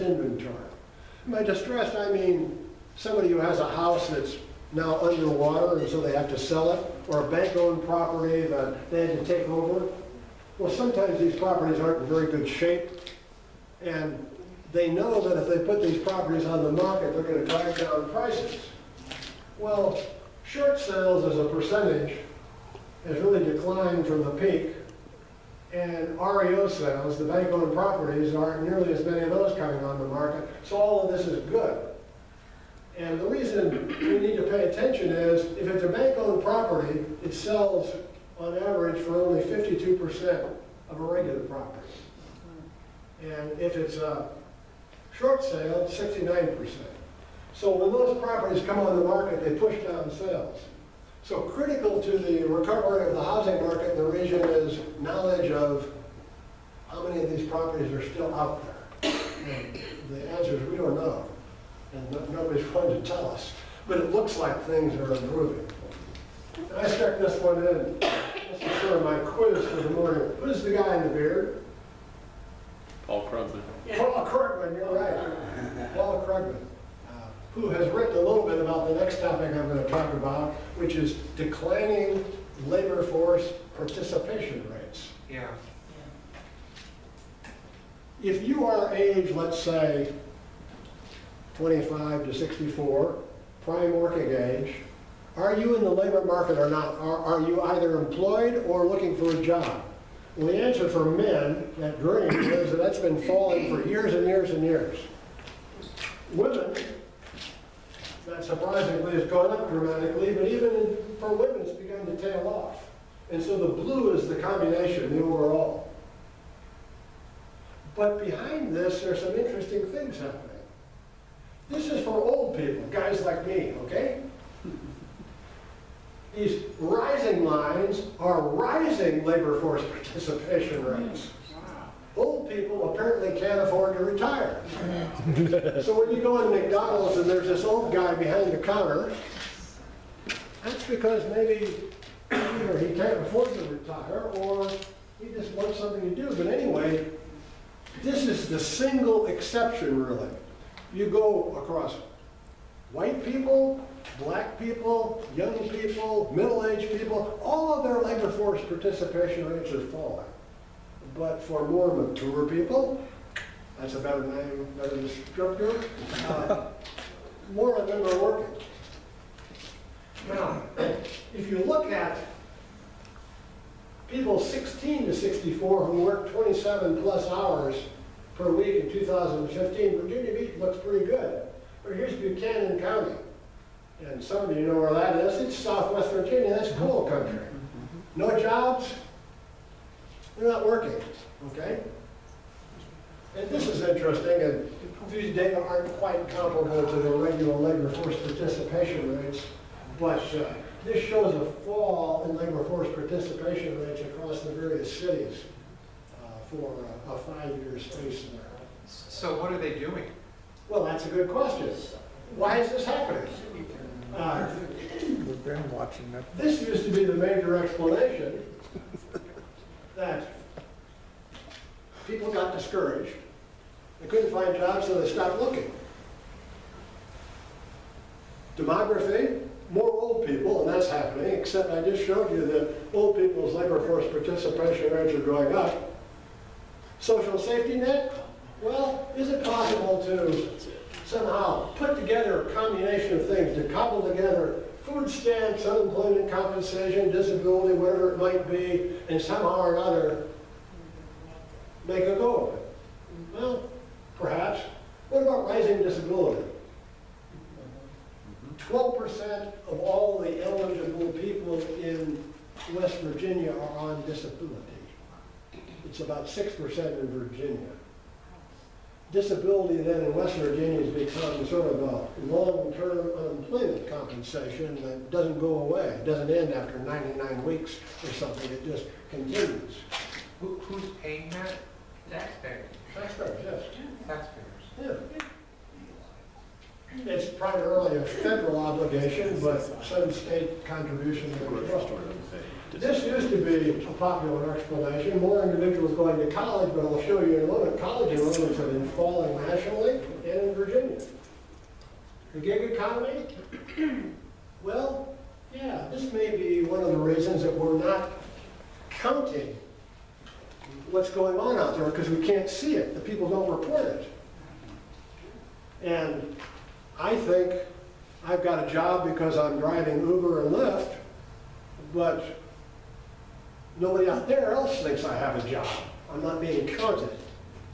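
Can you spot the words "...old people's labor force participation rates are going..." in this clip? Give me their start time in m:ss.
3:52.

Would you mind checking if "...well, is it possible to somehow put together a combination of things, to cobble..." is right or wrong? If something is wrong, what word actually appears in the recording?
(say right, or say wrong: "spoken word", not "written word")
right.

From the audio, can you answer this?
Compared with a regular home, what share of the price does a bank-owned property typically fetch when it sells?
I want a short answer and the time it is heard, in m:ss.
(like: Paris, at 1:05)
52%, at 0:39.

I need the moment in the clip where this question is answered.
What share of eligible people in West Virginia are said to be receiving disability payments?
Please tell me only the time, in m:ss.
4:18.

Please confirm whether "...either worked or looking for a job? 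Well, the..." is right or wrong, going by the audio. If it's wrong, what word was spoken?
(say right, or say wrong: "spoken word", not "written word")
wrong: "employed", not "worked".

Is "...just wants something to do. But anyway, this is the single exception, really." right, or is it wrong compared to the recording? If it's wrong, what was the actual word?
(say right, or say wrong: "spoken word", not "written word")
right.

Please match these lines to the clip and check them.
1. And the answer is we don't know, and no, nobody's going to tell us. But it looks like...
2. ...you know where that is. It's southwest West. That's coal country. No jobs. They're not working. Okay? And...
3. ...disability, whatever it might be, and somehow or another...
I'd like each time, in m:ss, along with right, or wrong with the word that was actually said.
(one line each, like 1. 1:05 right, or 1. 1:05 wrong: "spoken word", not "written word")
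1. 0:59 right
2. 3:04 wrong: "Virginia", not "West"
3. 4:07 right.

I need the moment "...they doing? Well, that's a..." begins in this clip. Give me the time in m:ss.
3:29.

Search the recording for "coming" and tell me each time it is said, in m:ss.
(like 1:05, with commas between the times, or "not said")
0:29.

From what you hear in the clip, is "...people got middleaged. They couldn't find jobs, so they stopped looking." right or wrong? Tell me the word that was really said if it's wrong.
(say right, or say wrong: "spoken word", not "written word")
wrong: "discouraged", not "middleaged".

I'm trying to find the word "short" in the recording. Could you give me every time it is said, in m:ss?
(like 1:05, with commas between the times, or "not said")
0:20, 0:45.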